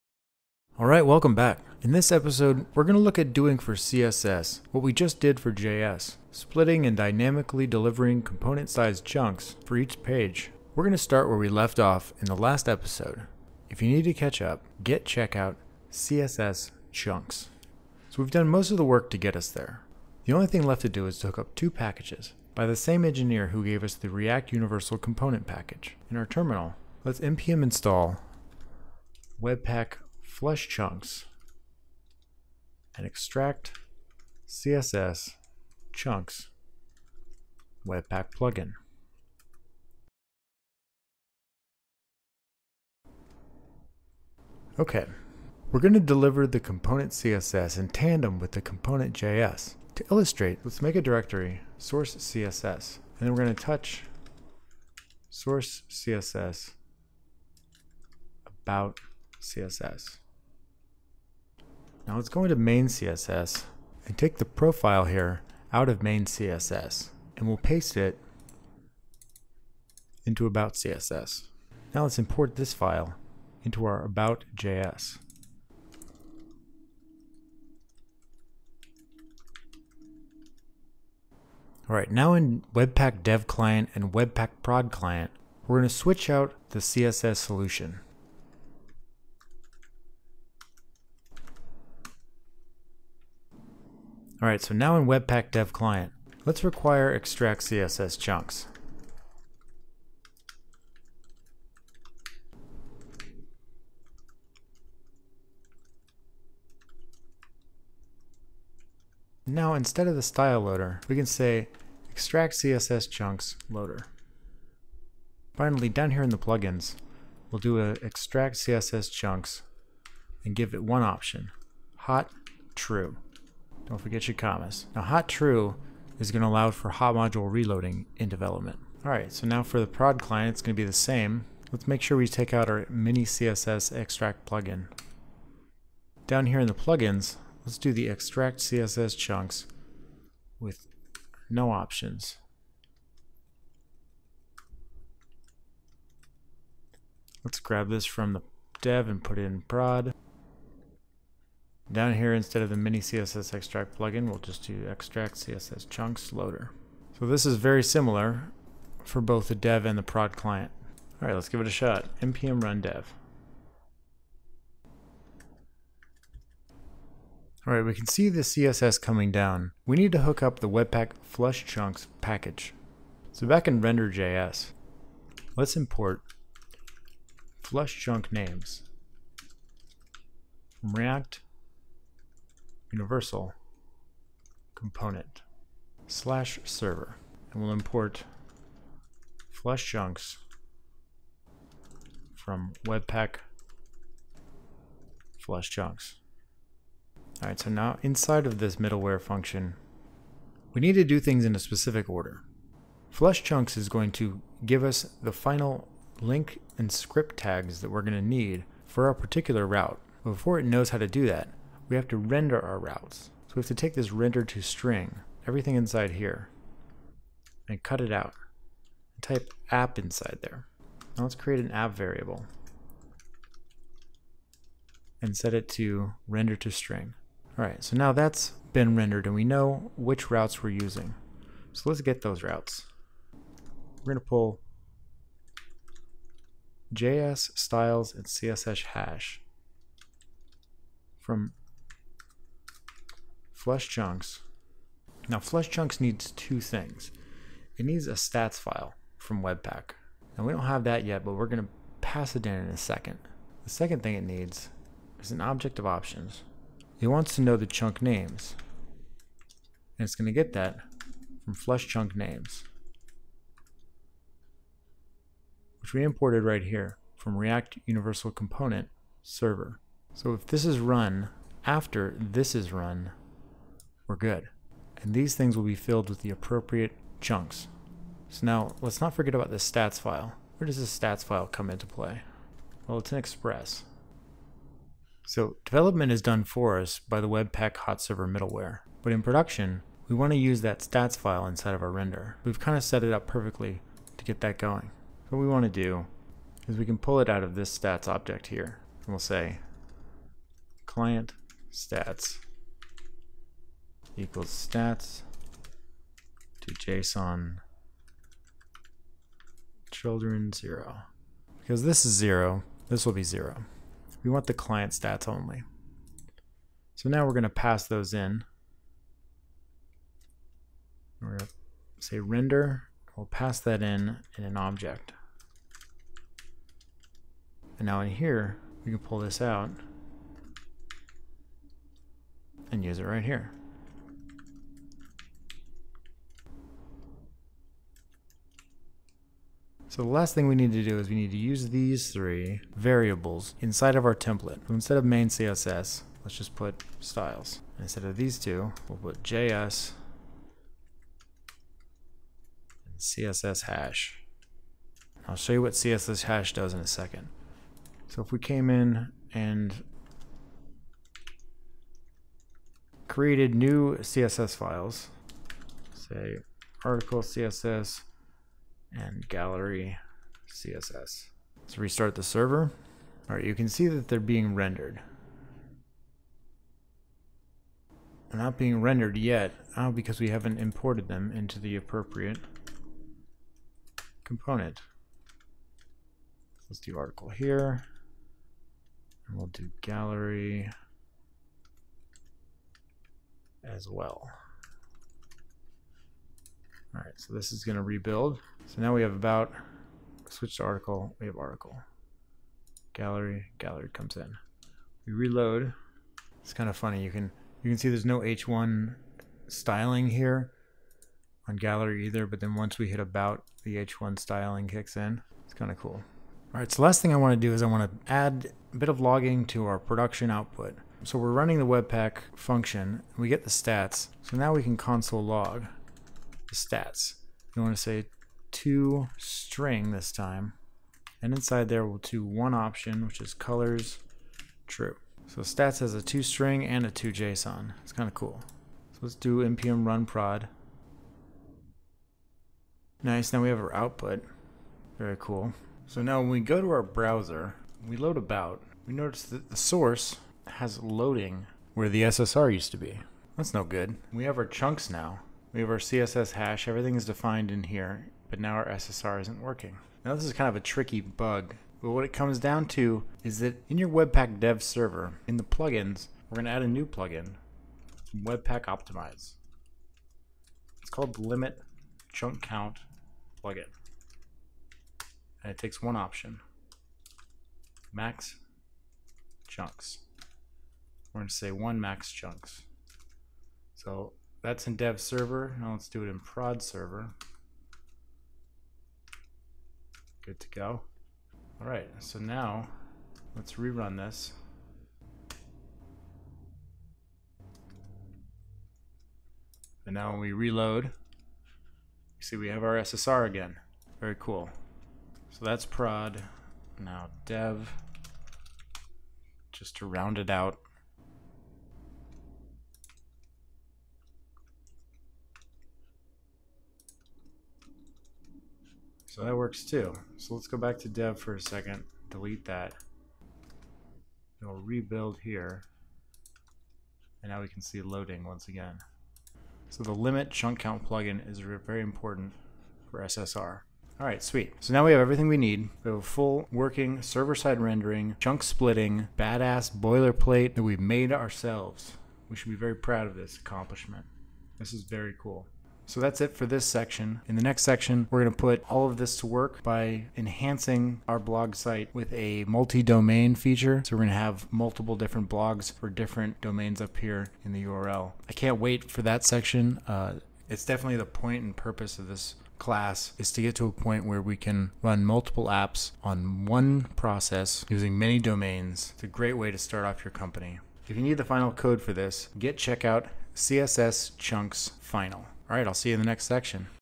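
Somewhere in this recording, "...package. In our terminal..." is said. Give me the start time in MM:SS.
00:25.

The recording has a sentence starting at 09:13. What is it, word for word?
So we're going to have multiple different blogs for different domains up here in the URL.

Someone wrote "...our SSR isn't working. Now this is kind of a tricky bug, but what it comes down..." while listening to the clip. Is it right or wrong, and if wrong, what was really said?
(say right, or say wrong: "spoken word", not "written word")
right.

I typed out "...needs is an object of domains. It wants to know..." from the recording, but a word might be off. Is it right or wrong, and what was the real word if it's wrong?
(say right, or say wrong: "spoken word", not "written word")
wrong: "options", not "domains".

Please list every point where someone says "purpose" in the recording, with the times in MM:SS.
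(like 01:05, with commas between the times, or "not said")
09:21.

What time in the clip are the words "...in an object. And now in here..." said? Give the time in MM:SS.
05:24.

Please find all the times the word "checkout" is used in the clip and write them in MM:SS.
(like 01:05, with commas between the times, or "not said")
00:15, 09:32.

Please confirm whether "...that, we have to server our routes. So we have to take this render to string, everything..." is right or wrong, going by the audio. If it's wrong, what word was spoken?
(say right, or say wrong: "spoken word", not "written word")
wrong: "render", not "server".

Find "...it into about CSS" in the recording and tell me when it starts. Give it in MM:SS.
01:07.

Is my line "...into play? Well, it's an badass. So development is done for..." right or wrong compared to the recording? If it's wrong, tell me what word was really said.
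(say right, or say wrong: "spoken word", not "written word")
wrong: "express", not "badass".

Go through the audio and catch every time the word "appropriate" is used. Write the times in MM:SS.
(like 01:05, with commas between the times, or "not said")
04:36, 06:21.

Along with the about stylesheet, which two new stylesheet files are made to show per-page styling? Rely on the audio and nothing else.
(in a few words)
article CSS and gallery CSS.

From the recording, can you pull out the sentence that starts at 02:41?
All right, let's give it a shot.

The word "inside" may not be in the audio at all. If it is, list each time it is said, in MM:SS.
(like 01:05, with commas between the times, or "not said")
03:18, 03:35, 03:39, 04:51, 05:43, 07:11.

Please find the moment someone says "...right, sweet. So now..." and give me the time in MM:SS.
08:54.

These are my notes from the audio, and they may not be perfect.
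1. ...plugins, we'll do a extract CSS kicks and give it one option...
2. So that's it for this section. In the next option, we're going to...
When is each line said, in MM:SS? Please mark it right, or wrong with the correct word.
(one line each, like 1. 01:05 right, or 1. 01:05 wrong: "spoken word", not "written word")
1. 01:56 wrong: "chunks", not "kicks"
2. 09:05 wrong: "section", not "option".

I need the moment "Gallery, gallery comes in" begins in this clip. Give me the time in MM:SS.
06:42.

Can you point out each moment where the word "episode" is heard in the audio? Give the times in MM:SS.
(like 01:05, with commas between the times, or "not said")
00:02, 00:12.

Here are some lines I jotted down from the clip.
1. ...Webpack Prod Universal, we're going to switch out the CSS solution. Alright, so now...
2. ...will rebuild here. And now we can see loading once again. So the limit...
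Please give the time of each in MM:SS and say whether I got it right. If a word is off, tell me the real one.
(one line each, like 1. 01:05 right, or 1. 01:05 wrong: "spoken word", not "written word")
1. 01:24 wrong: "Client", not "Universal"
2. 08:44 right.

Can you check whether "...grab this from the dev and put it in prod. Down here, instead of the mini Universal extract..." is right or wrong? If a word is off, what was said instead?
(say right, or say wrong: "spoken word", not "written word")
wrong: "CSS", not "Universal".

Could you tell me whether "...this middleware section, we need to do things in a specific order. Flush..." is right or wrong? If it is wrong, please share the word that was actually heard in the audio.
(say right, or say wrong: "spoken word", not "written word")
wrong: "function", not "section".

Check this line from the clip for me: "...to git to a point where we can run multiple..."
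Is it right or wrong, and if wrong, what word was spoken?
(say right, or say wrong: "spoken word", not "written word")
right.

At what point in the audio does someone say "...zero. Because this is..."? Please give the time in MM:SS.
05:10.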